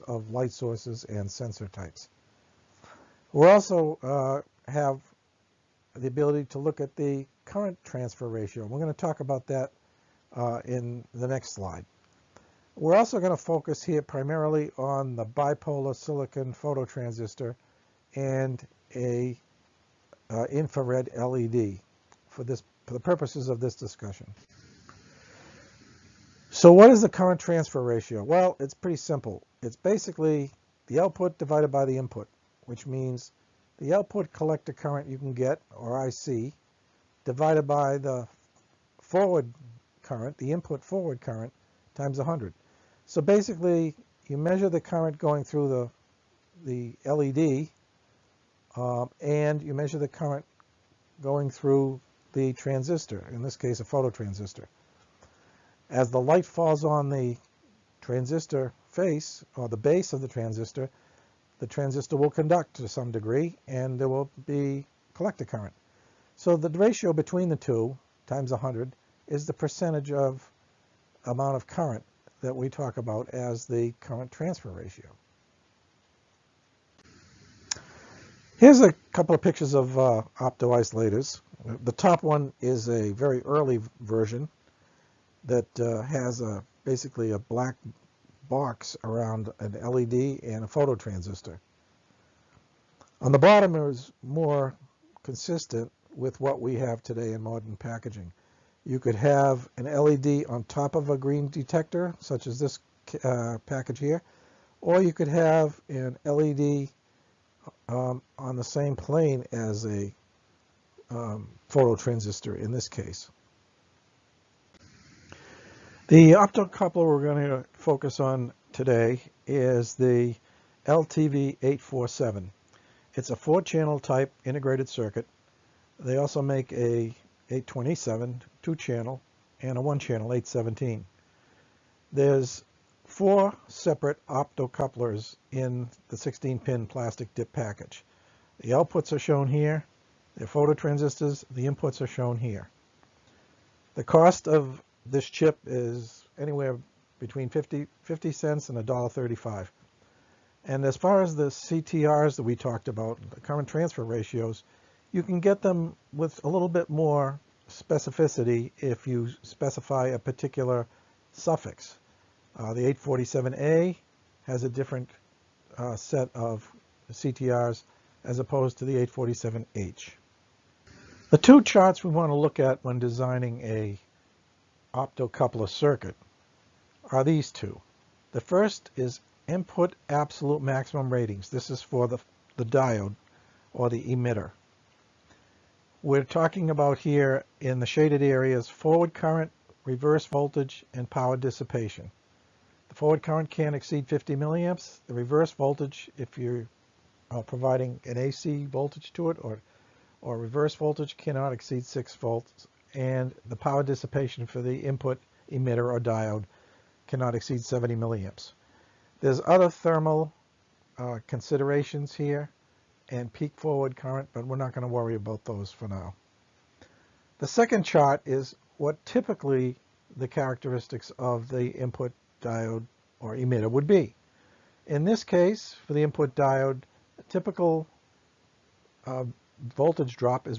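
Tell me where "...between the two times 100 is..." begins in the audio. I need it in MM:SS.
01:07.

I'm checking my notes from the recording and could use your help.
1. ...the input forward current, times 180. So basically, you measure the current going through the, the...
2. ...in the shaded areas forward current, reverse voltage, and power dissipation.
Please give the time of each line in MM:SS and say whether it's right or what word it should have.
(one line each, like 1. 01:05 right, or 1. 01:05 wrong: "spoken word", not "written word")
1. 00:40 wrong: "100", not "180"
2. 03:07 right.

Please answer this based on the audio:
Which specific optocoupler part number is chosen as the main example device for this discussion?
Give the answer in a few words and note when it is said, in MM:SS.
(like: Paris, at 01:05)
LTV847, at 02:00.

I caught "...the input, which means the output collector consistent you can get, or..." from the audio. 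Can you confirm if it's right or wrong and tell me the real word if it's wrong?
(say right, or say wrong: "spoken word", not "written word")
wrong: "current", not "consistent".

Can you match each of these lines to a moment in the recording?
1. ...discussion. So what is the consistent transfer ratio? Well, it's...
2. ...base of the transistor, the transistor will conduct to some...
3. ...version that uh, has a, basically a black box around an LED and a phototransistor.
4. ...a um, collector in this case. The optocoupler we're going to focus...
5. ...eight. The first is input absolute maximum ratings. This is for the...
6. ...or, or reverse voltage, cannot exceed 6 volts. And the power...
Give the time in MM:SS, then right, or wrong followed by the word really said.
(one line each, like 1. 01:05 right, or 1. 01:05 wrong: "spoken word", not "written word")
1. 00:23 wrong: "current", not "consistent"
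2. 00:59 right
3. 01:23 right
4. 01:49 wrong: "phototransistor", not "collector"
5. 02:57 wrong: "two", not "eight"
6. 03:19 right.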